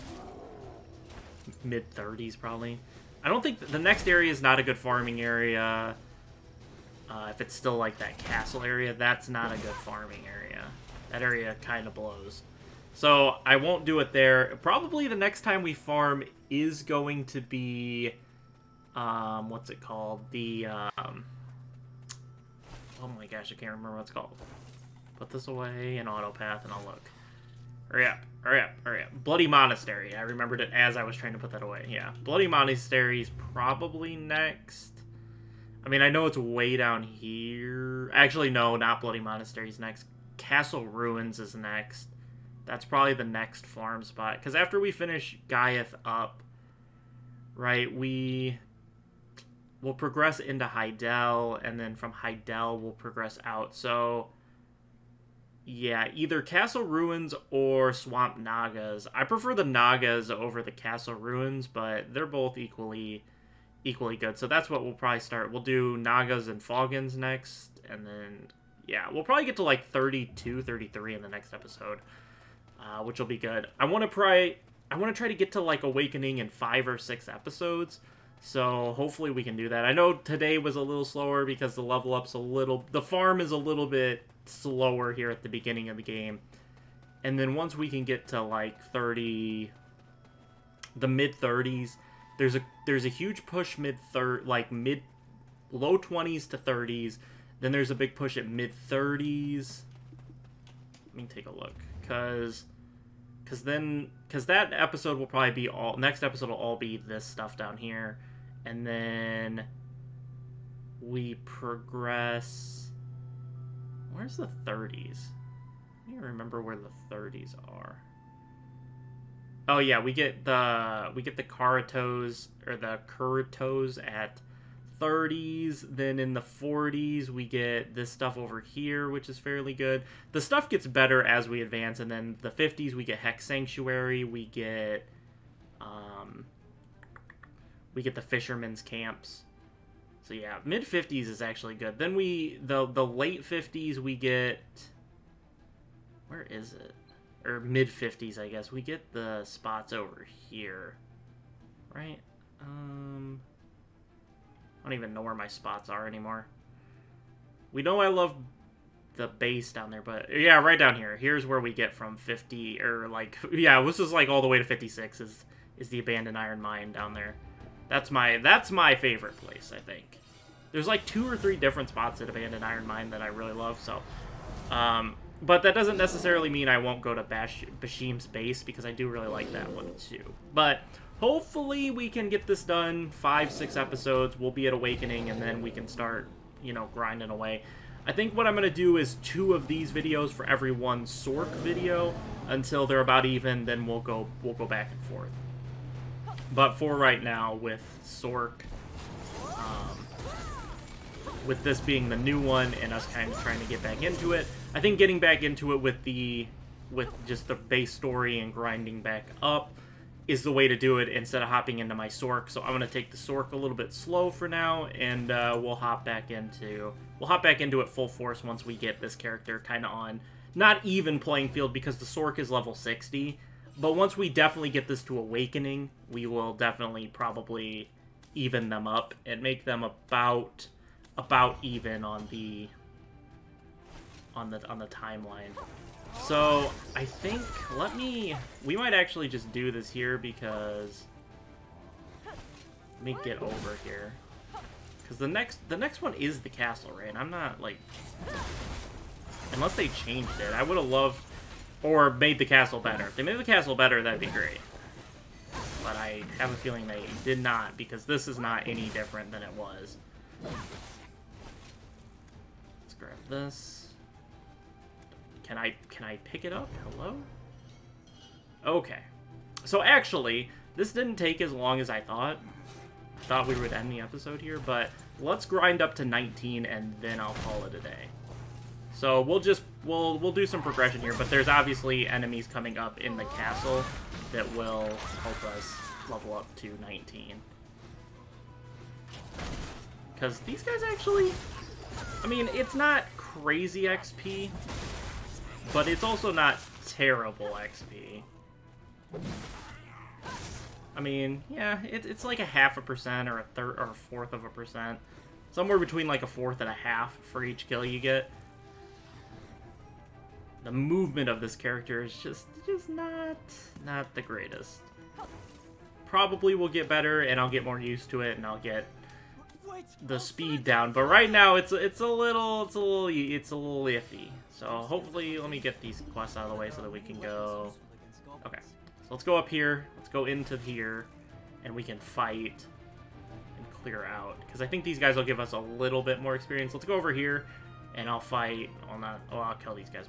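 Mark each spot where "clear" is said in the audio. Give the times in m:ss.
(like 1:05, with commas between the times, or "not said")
5:33.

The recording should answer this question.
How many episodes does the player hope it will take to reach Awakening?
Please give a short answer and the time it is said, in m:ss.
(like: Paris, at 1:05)
5 or 6, at 1:16.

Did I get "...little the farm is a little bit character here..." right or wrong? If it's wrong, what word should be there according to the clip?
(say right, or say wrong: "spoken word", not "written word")
wrong: "slower", not "character".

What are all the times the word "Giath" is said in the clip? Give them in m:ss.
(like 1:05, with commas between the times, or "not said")
0:45.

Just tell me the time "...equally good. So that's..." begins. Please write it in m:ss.
1:03.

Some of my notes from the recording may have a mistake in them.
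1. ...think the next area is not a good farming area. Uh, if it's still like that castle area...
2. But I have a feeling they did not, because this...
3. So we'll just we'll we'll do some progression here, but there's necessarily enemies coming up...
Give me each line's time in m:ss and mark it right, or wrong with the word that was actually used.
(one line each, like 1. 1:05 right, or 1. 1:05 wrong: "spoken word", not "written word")
1. 0:03 right
2. 4:15 right
3. 4:38 wrong: "obviously", not "necessarily".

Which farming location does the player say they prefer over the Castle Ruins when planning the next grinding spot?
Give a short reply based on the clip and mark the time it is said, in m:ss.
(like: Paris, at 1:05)
Swamp Nagas, at 0:57.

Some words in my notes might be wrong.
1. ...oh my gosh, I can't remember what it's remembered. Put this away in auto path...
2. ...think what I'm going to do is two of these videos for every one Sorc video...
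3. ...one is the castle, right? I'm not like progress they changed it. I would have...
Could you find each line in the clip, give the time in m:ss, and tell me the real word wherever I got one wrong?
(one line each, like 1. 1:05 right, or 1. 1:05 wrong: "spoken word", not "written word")
1. 0:23 wrong: "called", not "remembered"
2. 3:08 right
3. 4:06 wrong: "unless", not "progress".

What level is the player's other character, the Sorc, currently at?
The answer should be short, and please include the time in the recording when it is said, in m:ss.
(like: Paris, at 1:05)
60, at 3:42.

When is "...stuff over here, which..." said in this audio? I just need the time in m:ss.
2:08.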